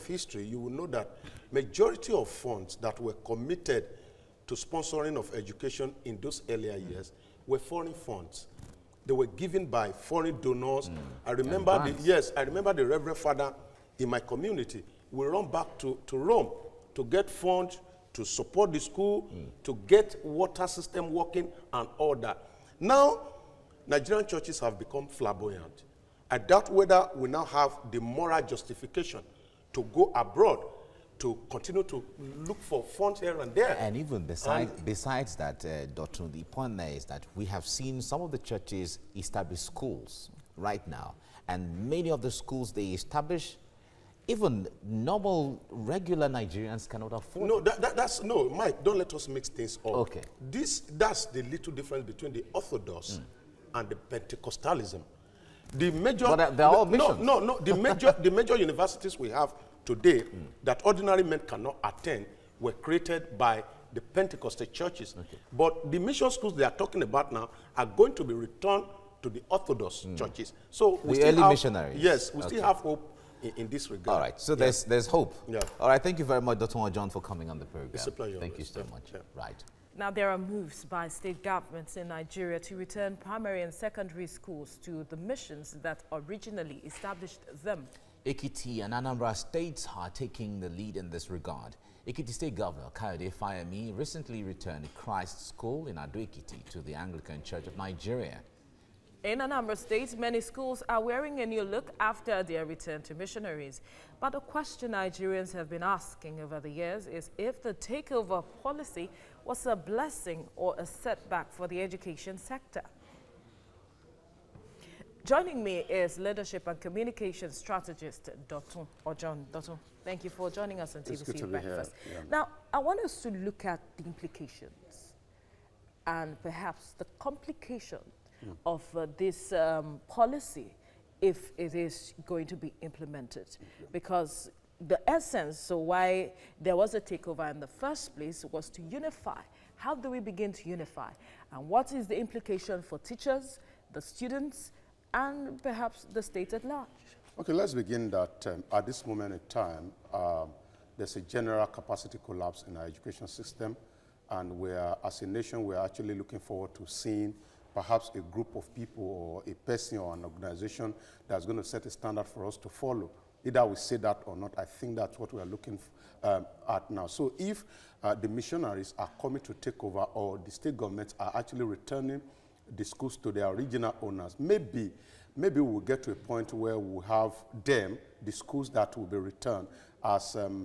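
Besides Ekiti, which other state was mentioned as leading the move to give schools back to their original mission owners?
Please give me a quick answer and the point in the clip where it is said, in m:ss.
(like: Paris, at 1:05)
Anambra, at 1:28.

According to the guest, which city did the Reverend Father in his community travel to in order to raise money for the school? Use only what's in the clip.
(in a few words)
Rome.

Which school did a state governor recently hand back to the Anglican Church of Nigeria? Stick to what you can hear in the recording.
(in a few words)
Christ School.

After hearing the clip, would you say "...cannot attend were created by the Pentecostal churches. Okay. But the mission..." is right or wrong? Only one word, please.
right.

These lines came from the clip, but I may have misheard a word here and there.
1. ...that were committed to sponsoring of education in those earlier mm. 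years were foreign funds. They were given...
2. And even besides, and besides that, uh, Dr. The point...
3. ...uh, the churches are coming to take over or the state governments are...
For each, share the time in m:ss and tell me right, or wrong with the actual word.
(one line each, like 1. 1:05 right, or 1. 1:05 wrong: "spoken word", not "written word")
1. 0:02 right
2. 0:33 right
3. 2:48 wrong: "missionaries", not "churches".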